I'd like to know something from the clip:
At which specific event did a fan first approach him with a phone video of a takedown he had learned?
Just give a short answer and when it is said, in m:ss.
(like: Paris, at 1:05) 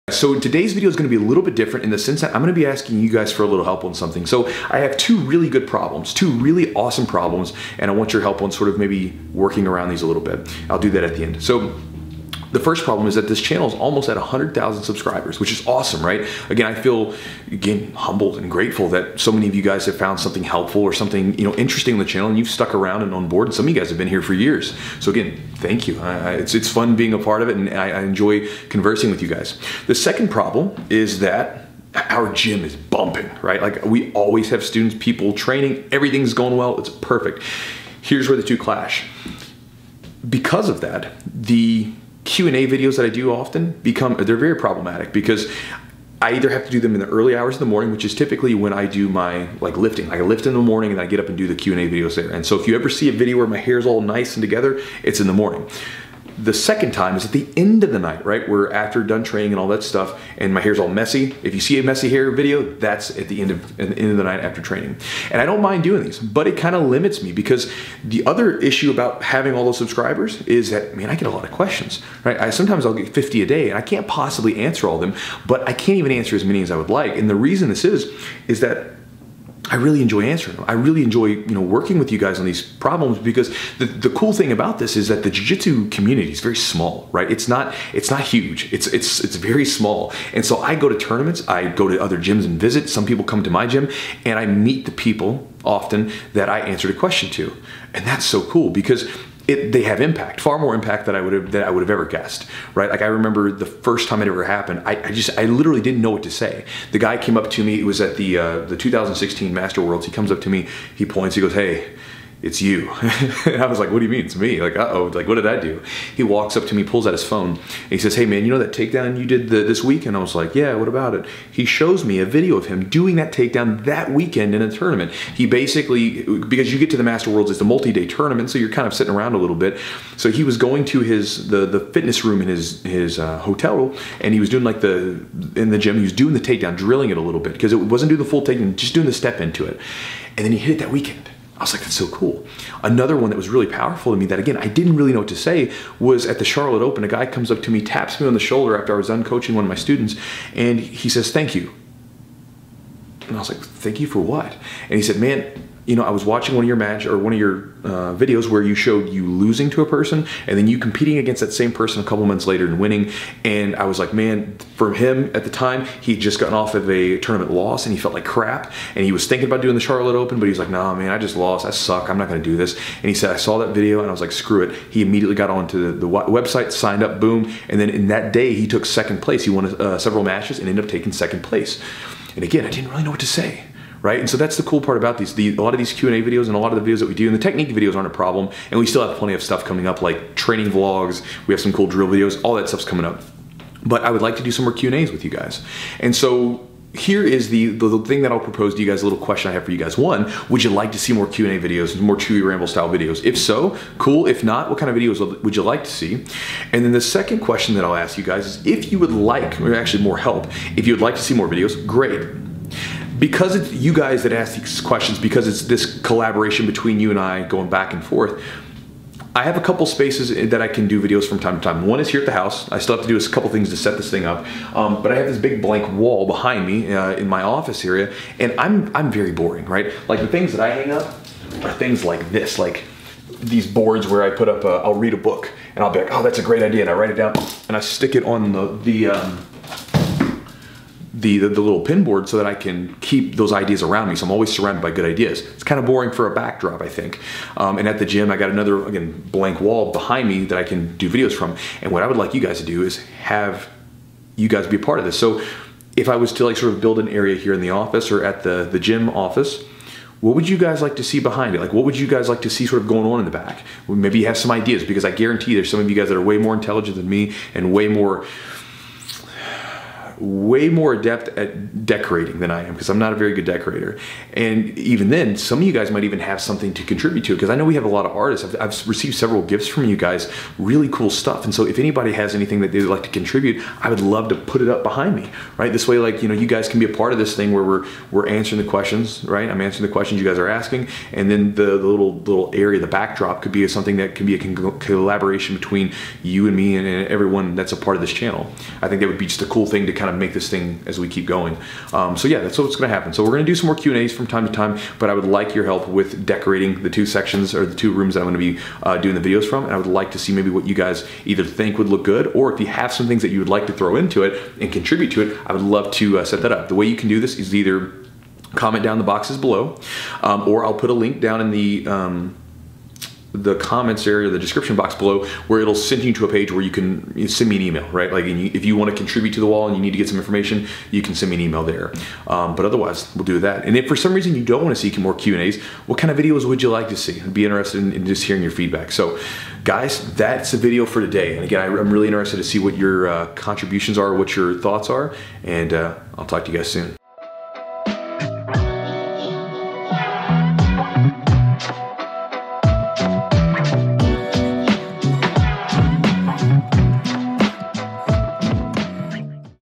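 2016 Master Worlds, at 1:48.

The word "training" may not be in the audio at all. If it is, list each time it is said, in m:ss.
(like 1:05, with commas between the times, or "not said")
0:35, 0:59, 1:04, 3:10.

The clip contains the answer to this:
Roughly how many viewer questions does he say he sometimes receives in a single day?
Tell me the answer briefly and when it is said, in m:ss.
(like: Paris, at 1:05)
50, at 1:13.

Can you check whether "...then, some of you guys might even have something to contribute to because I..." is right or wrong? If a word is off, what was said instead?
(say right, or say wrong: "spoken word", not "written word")
right.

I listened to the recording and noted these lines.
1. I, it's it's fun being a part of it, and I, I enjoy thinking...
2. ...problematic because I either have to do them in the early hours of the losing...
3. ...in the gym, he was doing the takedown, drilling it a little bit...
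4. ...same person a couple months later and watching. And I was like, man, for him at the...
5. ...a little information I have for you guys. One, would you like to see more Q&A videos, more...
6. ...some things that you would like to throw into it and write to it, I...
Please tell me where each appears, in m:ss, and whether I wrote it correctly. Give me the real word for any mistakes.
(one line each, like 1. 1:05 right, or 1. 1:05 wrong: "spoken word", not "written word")
1. 0:26 wrong: "conversing", not "thinking"
2. 0:44 wrong: "morning", not "losing"
3. 2:15 right
4. 2:41 wrong: "winning", not "watching"
5. 3:19 wrong: "question", not "information"
6. 5:12 wrong: "contribute", not "write".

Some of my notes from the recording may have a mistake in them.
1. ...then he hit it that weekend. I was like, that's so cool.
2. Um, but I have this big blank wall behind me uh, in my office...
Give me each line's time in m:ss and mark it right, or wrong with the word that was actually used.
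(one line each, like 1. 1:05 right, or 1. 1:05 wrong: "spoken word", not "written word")
1. 2:20 right
2. 3:44 right.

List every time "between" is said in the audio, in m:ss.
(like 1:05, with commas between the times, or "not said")
3:36, 4:55.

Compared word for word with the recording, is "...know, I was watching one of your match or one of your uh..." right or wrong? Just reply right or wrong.
right.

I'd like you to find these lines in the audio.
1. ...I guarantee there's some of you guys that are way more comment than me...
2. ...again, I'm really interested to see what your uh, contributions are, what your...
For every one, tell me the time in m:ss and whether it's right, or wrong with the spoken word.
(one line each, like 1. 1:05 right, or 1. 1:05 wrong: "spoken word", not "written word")
1. 4:25 wrong: "intelligent", not "comment"
2. 5:41 right.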